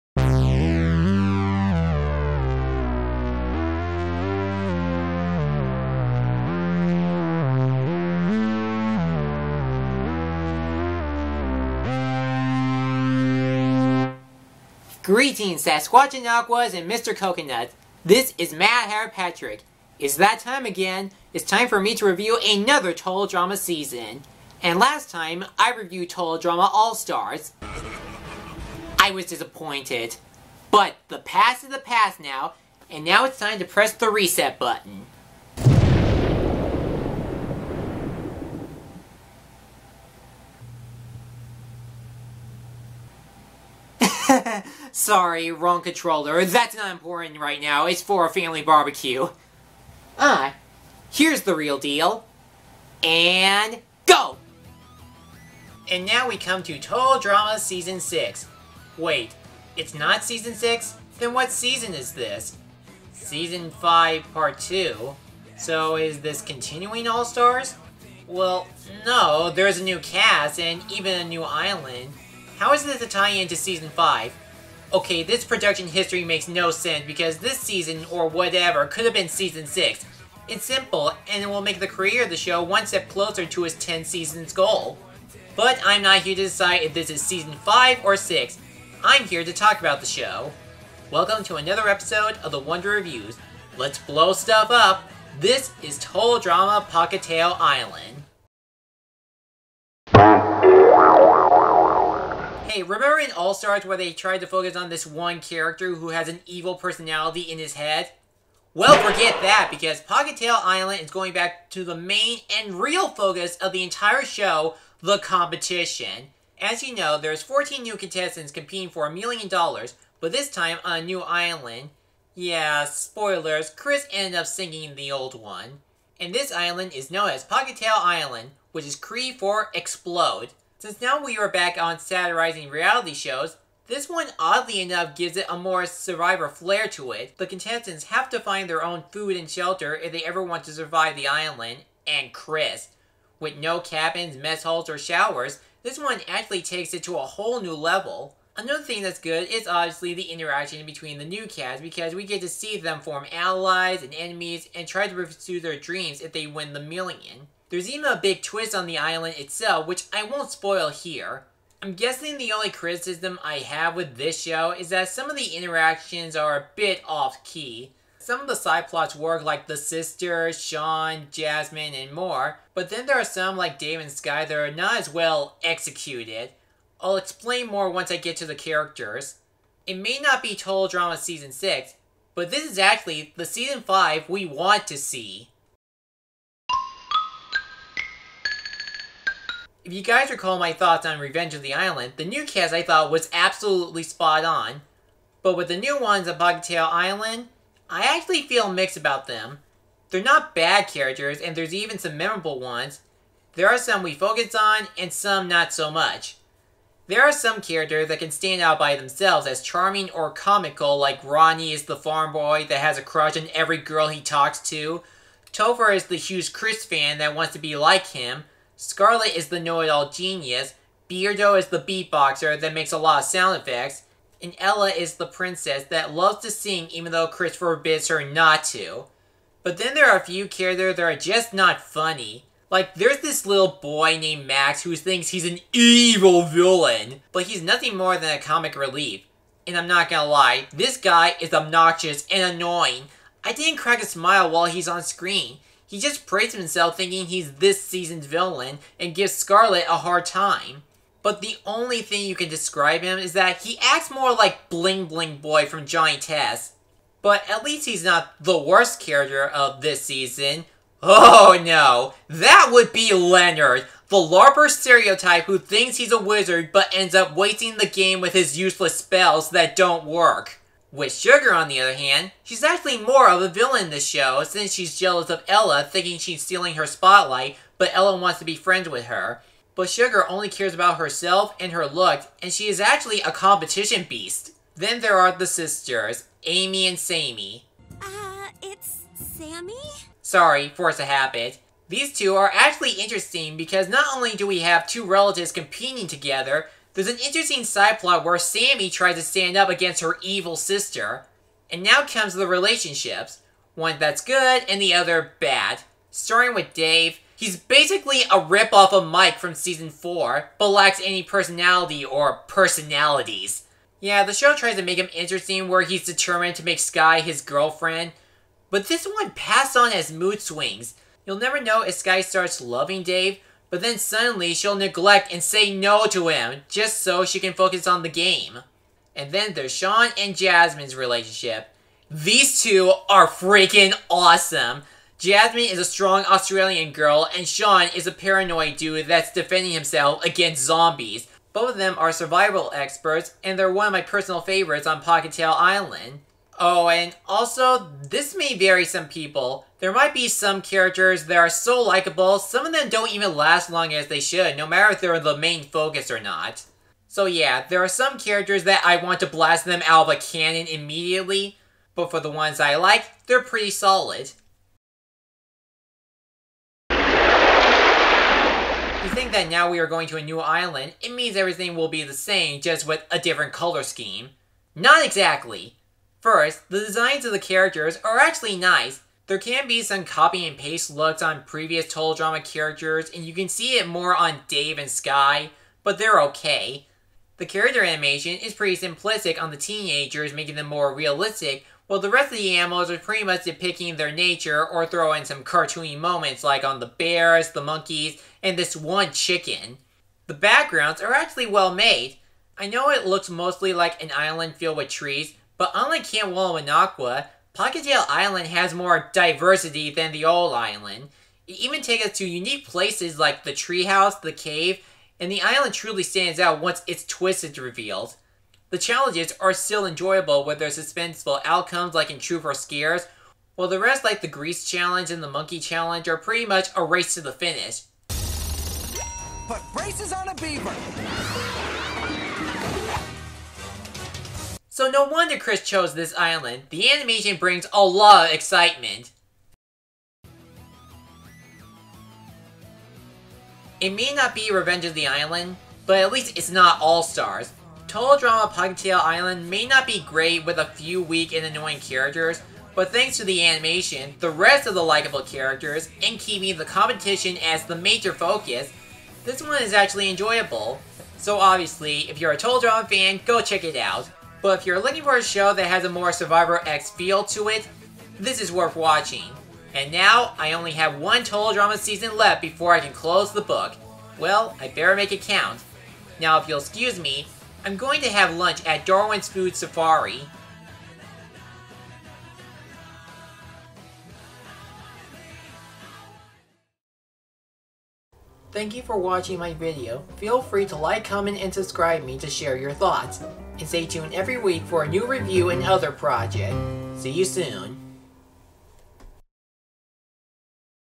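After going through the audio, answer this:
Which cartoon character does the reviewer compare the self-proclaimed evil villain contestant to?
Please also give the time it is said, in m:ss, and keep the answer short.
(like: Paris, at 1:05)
Bling Bling Boy, at 4:14.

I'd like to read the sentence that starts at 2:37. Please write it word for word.
There's even a big twist on the island itself, which I won't spoil here.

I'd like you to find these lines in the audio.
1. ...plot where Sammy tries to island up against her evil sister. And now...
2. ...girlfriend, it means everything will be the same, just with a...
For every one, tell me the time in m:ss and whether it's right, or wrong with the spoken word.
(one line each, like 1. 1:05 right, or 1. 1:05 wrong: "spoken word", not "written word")
1. 4:57 wrong: "stand", not "island"
2. 6:10 wrong: "island", not "girlfriend".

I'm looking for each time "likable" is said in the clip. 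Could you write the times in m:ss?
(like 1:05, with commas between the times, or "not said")
5:51, 7:34.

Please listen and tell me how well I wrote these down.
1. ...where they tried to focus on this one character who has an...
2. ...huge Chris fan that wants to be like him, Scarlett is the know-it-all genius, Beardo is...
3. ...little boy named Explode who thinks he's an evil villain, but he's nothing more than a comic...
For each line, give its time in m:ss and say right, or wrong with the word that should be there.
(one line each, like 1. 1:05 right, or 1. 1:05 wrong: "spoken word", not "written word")
1. 1:43 right
2. 3:36 right
3. 3:53 wrong: "Max", not "Explode".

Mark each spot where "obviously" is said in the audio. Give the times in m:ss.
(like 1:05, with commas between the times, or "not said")
2:29, 7:41.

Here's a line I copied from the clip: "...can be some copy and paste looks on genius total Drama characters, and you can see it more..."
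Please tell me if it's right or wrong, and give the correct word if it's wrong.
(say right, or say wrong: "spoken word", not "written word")
wrong: "previous", not "genius".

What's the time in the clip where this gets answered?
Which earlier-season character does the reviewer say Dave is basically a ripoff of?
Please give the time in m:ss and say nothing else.
5:09.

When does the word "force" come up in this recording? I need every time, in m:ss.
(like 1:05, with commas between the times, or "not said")
4:50.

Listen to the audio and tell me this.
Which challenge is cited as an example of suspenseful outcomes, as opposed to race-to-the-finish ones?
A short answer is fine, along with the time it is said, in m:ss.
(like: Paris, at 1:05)
Truth or Scares, at 7:02.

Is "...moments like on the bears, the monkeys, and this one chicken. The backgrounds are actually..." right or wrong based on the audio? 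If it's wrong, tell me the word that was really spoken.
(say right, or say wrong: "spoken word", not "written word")
right.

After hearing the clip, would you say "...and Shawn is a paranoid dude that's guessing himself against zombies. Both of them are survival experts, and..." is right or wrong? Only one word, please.
wrong.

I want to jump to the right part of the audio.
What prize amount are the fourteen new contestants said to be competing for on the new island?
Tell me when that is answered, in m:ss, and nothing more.
1:59.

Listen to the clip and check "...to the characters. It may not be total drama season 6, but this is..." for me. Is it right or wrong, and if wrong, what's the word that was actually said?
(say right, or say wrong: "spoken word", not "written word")
right.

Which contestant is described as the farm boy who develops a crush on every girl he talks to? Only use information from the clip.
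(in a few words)
Ronnie.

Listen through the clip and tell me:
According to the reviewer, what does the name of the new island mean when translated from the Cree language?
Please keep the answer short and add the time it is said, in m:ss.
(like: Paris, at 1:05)
Explode, at 2:09.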